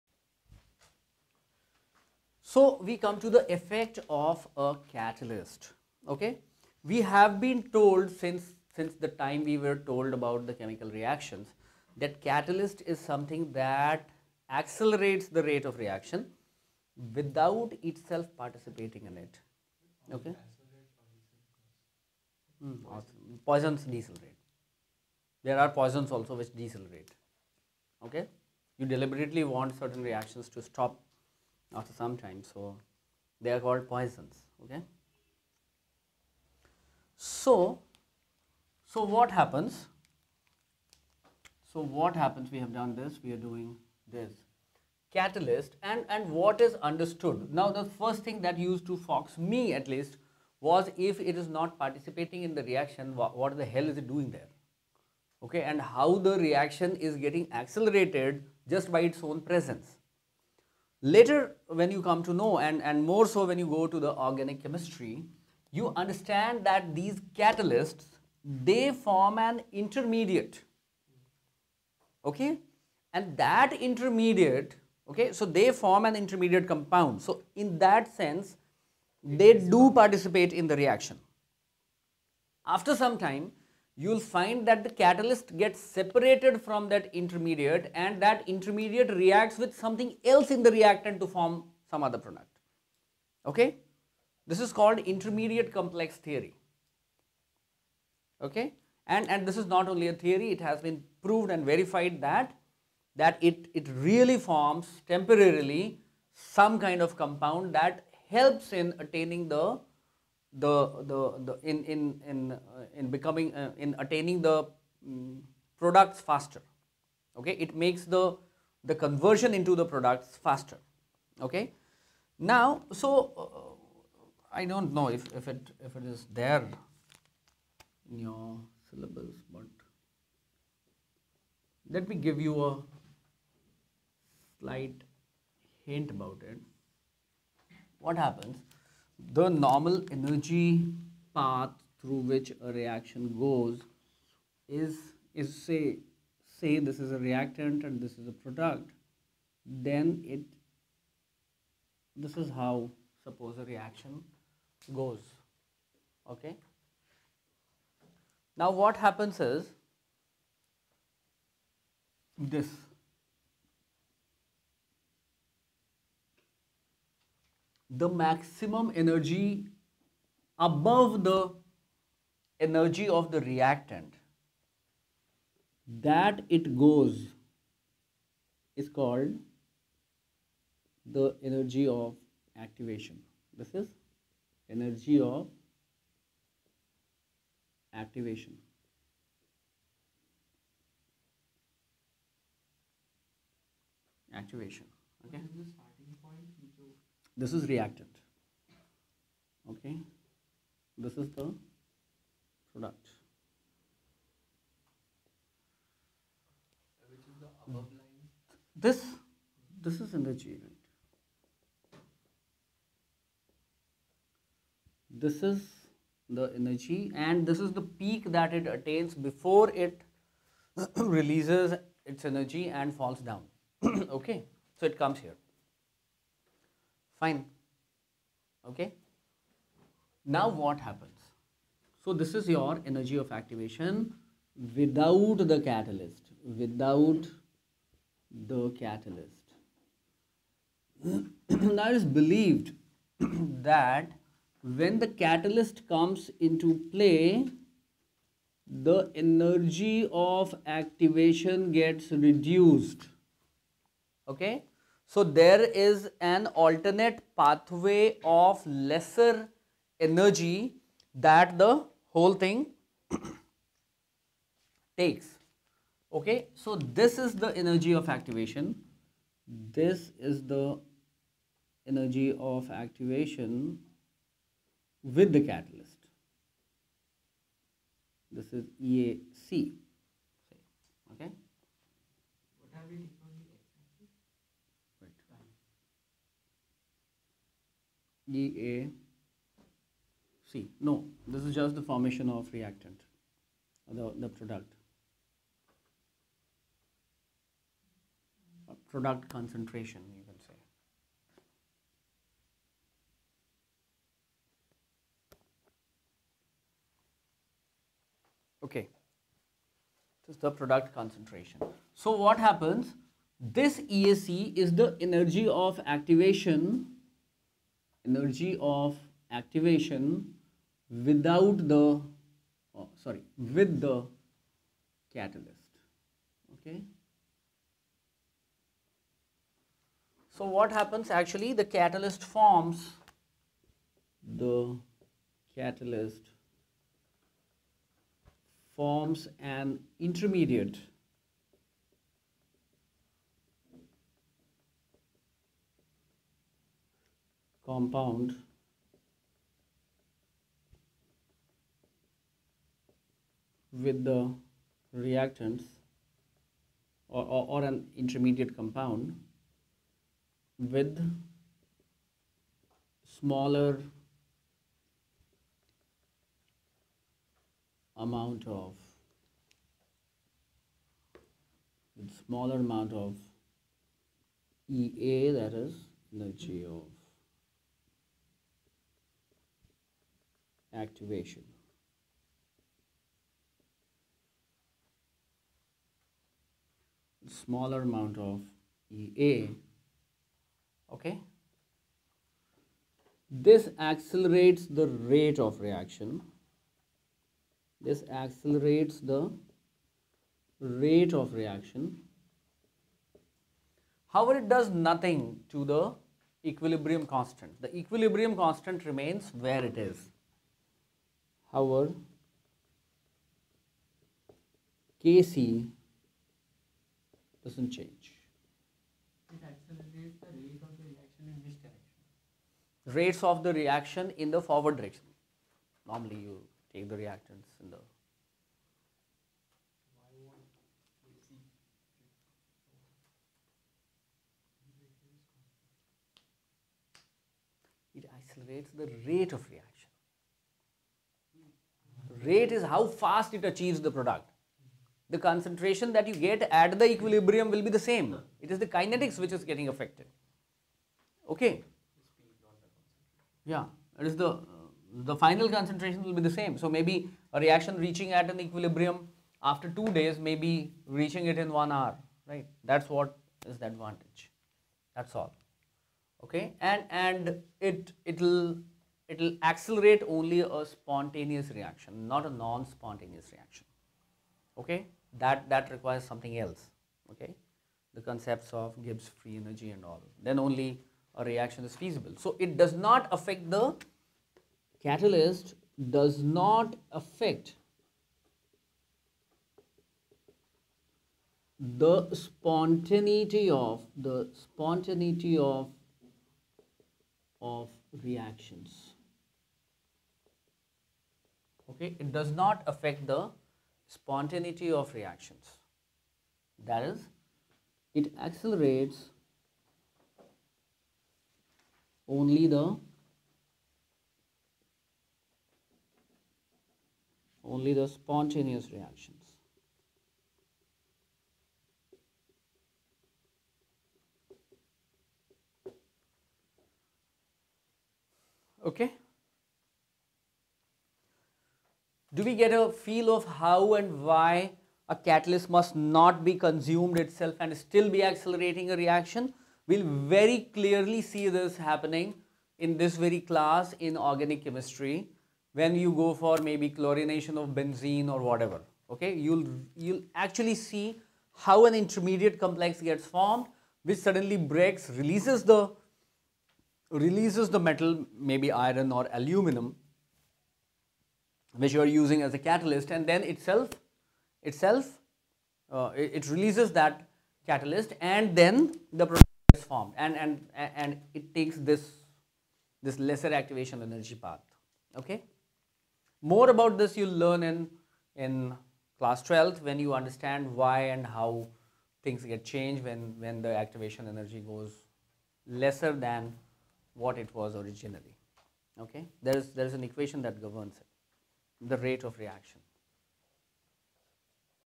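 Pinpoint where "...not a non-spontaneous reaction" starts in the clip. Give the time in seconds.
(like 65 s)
472 s.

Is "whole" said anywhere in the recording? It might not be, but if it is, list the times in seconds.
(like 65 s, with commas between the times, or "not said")
262 s.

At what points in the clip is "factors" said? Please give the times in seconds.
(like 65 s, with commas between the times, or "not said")
not said.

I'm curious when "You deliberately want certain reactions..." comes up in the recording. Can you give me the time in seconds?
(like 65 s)
28 s.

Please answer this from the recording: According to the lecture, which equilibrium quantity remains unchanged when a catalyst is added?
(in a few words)
Kc.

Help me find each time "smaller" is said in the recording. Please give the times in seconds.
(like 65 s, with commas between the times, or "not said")
363 s, 372 s, 387 s.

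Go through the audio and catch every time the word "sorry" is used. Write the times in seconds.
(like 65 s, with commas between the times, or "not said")
323 s.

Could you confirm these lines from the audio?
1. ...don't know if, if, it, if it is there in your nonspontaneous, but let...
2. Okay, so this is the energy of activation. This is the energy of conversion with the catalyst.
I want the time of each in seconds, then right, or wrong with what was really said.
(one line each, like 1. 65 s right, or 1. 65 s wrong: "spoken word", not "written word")
1. 124 s wrong: "syllabus", not "nonspontaneous"
2. 266 s wrong: "activation", not "conversion".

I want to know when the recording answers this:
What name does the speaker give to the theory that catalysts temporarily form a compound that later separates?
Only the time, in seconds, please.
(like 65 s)
94 s.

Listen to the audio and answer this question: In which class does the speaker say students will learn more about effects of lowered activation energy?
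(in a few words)
Class 12.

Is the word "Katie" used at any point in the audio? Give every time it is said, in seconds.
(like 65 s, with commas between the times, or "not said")
not said.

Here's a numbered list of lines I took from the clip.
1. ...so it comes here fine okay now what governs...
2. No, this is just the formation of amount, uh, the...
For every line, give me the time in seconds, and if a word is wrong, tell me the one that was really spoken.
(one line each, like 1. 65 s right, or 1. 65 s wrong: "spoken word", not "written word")
1. 224 s wrong: "happens", not "governs"
2. 290 s wrong: "reactant", not "amount".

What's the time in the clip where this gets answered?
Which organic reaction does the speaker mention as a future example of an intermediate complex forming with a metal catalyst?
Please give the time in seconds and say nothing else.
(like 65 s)
546 s.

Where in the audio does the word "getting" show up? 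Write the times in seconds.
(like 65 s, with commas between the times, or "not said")
57 s, 449 s.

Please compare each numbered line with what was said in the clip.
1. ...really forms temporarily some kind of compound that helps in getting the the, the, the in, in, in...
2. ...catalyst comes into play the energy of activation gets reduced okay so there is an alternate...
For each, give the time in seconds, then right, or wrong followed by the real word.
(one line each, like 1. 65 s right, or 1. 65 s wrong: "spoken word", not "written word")
1. 103 s wrong: "attaining", not "getting"
2. 245 s right.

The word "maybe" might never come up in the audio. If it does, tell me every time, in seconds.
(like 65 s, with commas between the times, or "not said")
456 s, 546 s, 558 s.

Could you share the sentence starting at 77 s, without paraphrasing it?
So in that sense, they do participate in the reaction.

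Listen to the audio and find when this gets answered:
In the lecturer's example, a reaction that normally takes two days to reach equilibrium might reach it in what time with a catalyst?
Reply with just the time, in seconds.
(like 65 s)
461 s.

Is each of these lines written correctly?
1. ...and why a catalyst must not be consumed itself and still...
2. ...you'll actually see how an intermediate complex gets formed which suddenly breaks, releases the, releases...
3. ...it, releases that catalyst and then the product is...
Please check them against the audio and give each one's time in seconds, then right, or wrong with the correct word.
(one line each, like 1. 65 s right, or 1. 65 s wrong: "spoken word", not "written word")
1. 533 s right
2. 549 s right
3. 566 s right.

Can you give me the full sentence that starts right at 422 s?
Rates of the reaction in the forward direction.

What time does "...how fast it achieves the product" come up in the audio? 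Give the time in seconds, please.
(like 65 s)
442 s.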